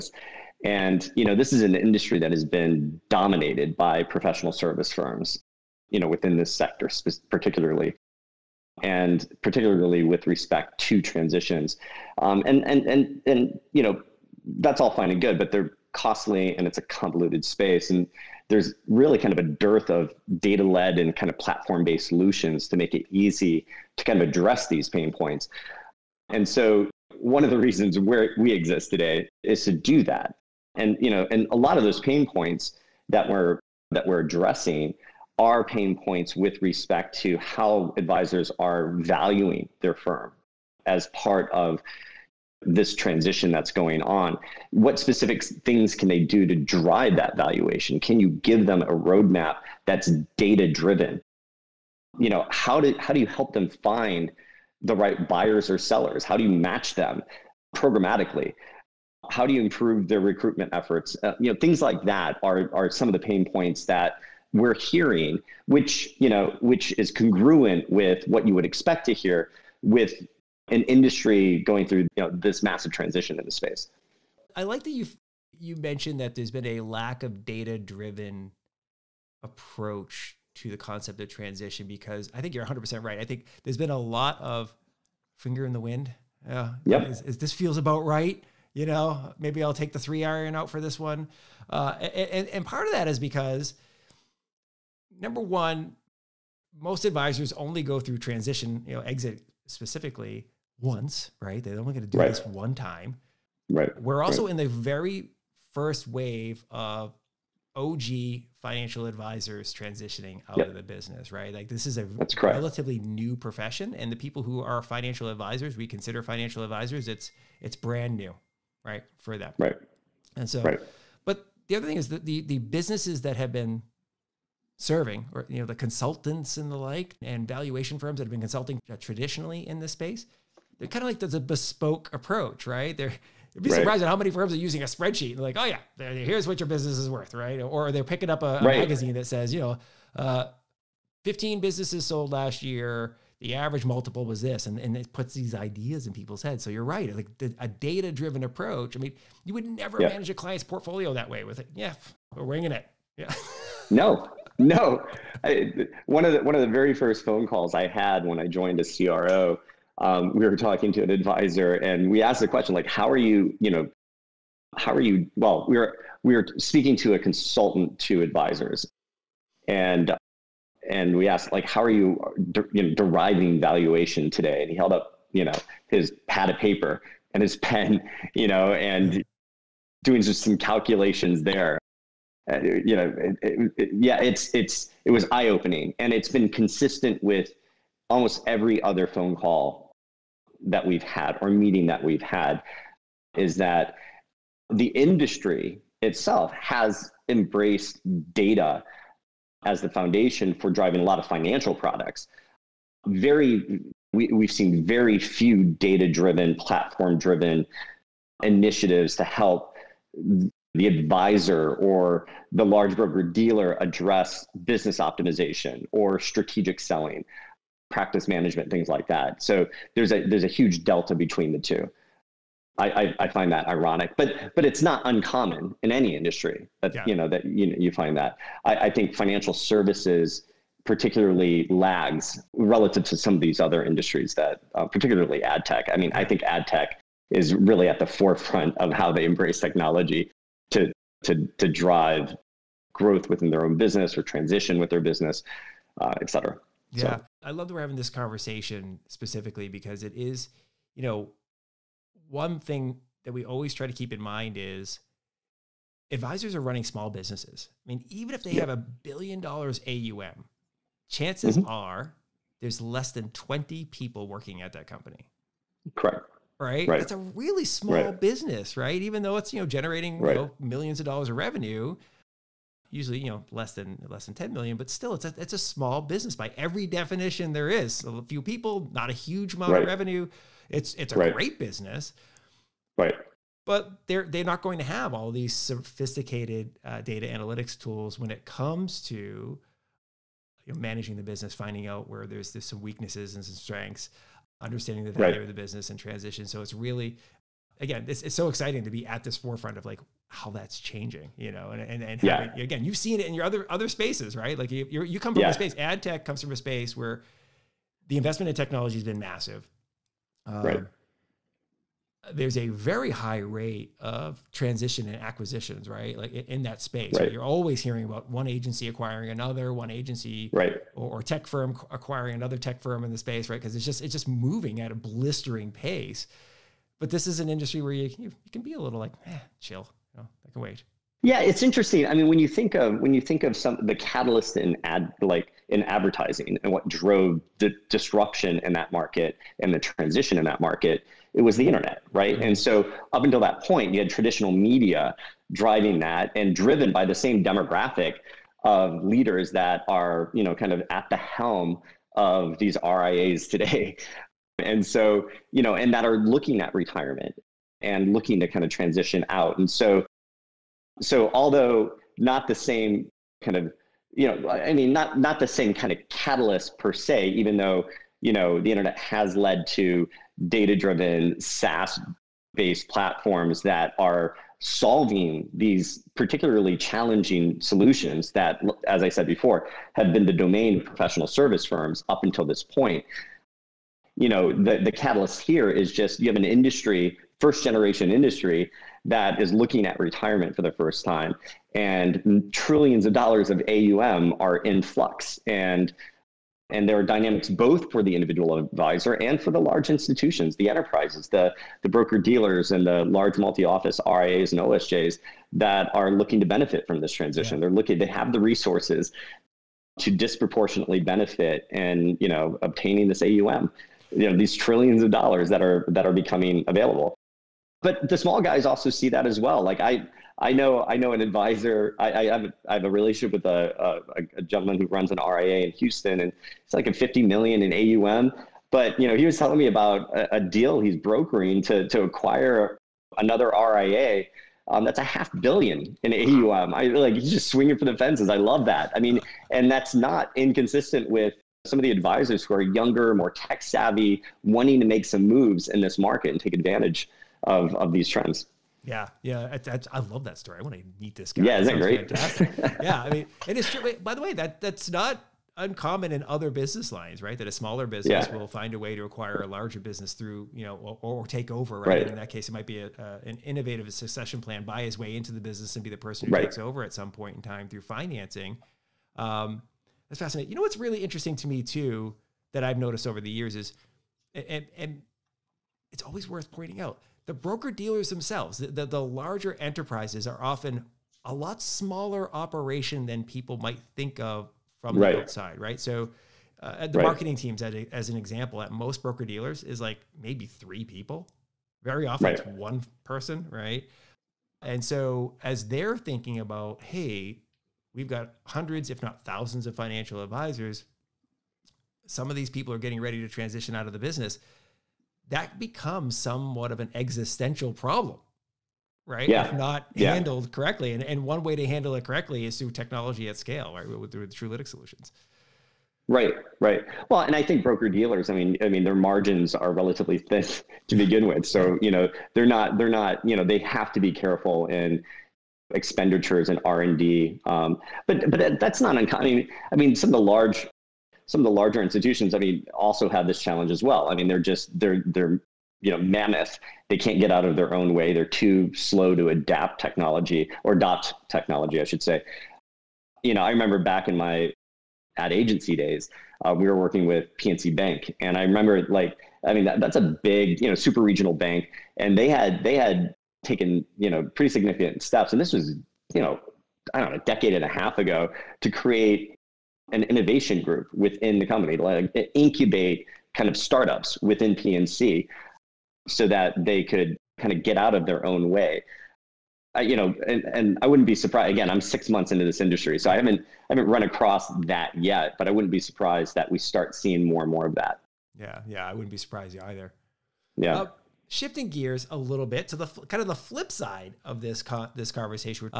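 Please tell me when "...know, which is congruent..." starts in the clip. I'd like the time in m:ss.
1:06.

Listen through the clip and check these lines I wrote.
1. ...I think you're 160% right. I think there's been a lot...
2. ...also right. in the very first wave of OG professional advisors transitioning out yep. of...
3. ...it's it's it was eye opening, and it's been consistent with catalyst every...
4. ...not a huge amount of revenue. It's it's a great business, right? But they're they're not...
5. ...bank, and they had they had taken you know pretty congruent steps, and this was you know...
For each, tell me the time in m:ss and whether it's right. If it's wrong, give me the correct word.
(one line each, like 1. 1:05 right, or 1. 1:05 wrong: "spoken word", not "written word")
1. 1:22 wrong: "100", not "160"
2. 1:44 wrong: "financial", not "professional"
3. 3:04 wrong: "almost", not "catalyst"
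4. 4:38 right
5. 9:11 wrong: "significant", not "congruent".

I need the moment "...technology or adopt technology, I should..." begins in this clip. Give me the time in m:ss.
8:59.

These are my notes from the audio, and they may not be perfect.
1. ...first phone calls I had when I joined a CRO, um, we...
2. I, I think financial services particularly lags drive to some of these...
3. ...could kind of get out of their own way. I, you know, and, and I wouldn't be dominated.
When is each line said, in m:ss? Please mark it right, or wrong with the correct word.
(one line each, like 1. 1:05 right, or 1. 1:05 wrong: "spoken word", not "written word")
1. 2:36 right
2. 3:48 wrong: "relative", not "drive"
3. 9:26 wrong: "surprised", not "dominated".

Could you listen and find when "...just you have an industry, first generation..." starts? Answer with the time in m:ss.
6:25.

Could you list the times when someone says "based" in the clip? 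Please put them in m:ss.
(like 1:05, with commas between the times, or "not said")
0:21, 6:12.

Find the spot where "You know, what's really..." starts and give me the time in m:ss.
7:50.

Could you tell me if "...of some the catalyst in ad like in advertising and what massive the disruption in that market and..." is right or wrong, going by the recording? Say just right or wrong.
wrong.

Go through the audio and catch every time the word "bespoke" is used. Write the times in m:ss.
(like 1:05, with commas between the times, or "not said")
2:11.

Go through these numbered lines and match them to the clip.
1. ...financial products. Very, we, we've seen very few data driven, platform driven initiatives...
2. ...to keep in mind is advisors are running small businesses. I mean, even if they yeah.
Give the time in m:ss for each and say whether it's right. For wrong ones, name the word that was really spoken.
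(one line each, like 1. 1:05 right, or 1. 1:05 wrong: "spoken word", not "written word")
1. 3:21 right
2. 4:13 right.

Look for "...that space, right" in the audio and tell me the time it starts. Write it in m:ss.
5:16.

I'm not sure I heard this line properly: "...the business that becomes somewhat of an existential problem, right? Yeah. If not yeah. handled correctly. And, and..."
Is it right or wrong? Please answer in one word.
right.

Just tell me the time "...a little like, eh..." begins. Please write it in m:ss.
5:28.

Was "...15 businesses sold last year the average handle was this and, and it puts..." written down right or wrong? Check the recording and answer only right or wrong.
wrong.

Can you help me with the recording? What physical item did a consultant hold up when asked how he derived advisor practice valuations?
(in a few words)
pad of paper.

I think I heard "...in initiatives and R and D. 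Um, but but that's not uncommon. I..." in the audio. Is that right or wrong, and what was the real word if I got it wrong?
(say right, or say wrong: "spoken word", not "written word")
wrong: "expenditures", not "initiatives".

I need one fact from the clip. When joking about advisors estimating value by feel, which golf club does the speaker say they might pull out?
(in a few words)
three iron.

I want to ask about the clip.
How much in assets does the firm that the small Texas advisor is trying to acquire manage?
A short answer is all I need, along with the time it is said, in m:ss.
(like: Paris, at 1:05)
half billion, at 7:15.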